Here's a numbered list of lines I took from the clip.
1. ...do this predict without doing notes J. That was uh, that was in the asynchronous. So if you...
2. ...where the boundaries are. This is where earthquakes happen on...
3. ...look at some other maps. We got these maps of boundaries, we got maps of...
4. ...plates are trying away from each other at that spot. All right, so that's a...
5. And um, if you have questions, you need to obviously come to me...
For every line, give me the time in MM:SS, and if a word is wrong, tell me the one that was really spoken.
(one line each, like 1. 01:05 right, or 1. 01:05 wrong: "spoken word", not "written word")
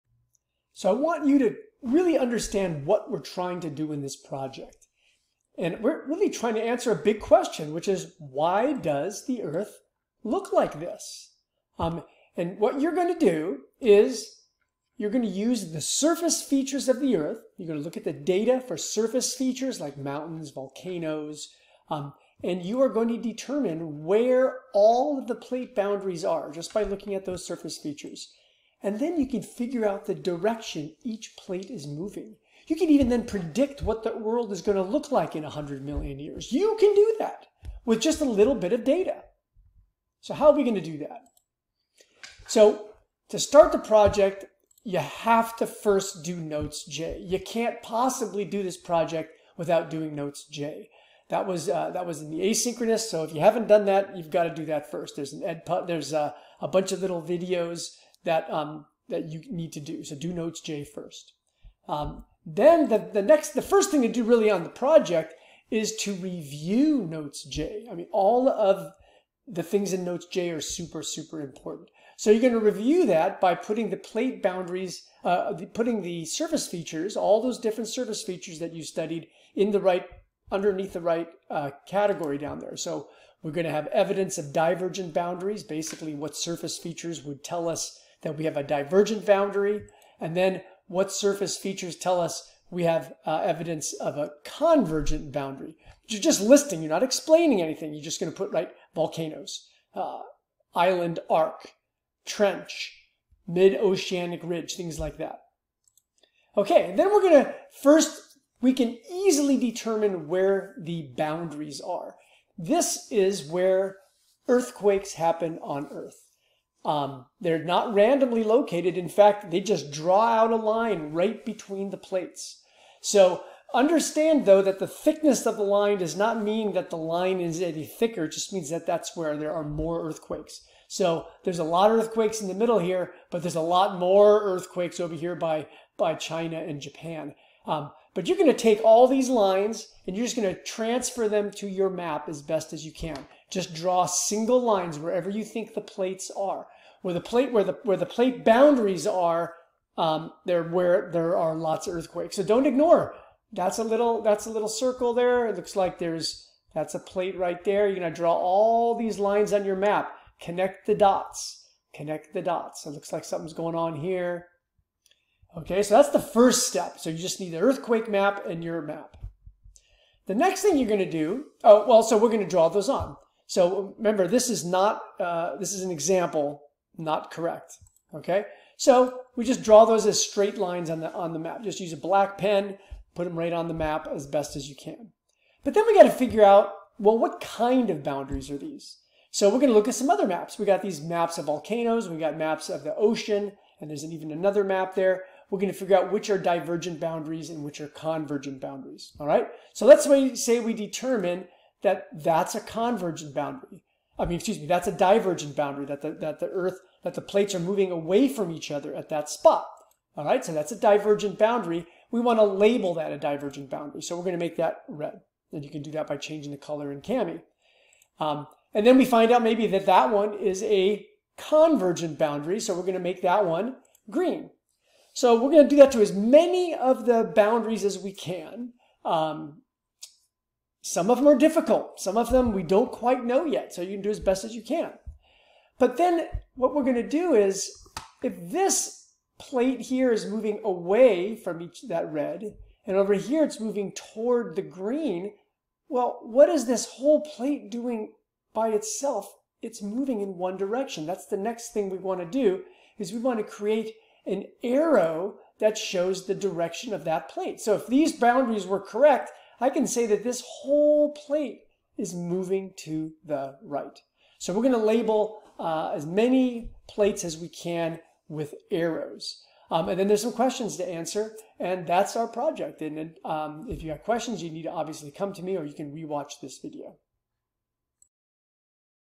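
1. 00:48 wrong: "project", not "predict"
2. 01:50 right
3. 03:09 wrong: "volcanoes", not "boundaries"
4. 03:27 wrong: "moving", not "trying"
5. 04:32 right.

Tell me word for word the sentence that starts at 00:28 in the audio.
And then you can figure out the direction each plate is moving.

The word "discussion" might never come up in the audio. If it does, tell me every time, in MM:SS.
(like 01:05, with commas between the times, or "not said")
not said.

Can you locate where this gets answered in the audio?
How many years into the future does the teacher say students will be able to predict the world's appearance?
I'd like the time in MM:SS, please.
00:35.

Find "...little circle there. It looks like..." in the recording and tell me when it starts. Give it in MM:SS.
02:34.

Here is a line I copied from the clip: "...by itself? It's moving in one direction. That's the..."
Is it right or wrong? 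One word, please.
right.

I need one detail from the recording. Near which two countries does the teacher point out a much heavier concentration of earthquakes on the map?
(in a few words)
China and Japan.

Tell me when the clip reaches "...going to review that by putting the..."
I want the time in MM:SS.
01:12.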